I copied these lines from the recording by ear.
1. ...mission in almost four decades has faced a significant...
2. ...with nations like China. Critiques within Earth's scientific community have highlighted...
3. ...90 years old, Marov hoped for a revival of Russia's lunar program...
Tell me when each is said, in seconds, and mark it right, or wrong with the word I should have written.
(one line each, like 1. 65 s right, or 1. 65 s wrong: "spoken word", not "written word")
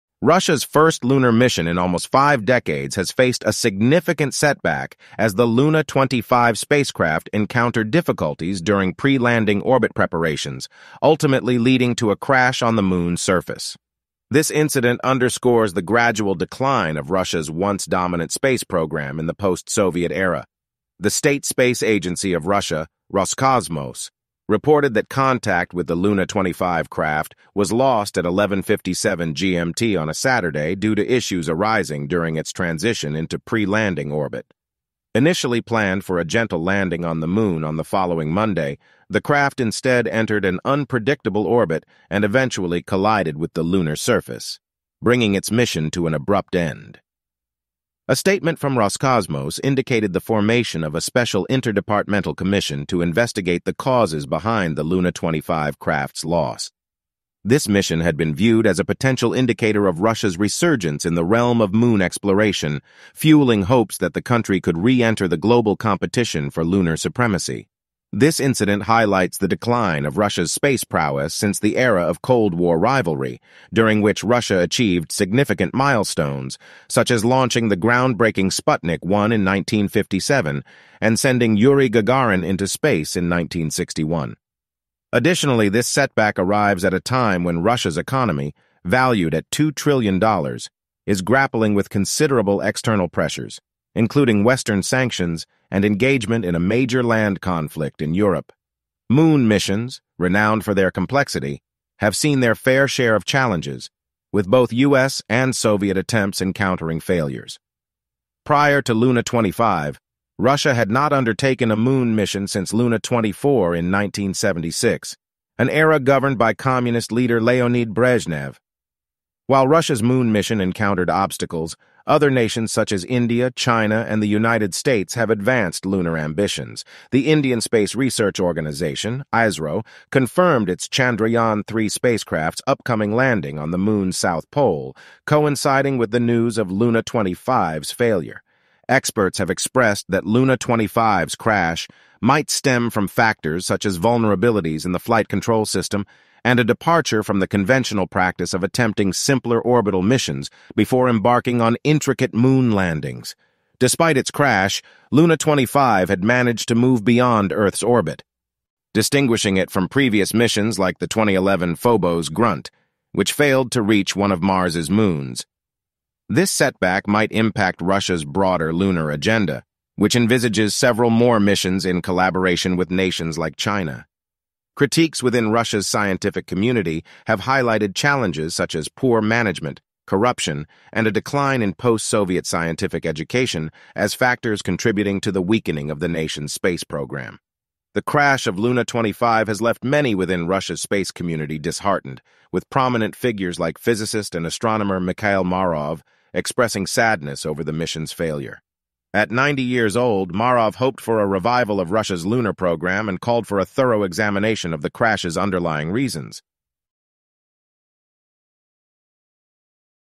1. 1 s wrong: "five", not "four"
2. 172 s wrong: "Russia", not "Earth"
3. 199 s right.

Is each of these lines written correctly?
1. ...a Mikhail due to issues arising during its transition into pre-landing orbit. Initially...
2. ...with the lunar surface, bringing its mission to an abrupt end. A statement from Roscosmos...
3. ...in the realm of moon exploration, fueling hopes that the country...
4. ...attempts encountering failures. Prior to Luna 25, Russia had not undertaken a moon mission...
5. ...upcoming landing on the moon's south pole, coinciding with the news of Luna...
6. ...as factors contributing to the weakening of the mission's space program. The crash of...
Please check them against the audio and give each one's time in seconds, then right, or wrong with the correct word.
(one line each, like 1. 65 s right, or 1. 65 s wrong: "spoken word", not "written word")
1. 30 s wrong: "Saturday", not "Mikhail"
2. 43 s right
3. 61 s right
4. 105 s right
5. 132 s right
6. 183 s wrong: "nation", not "mission".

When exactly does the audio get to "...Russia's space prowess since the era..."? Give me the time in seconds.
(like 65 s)
70 s.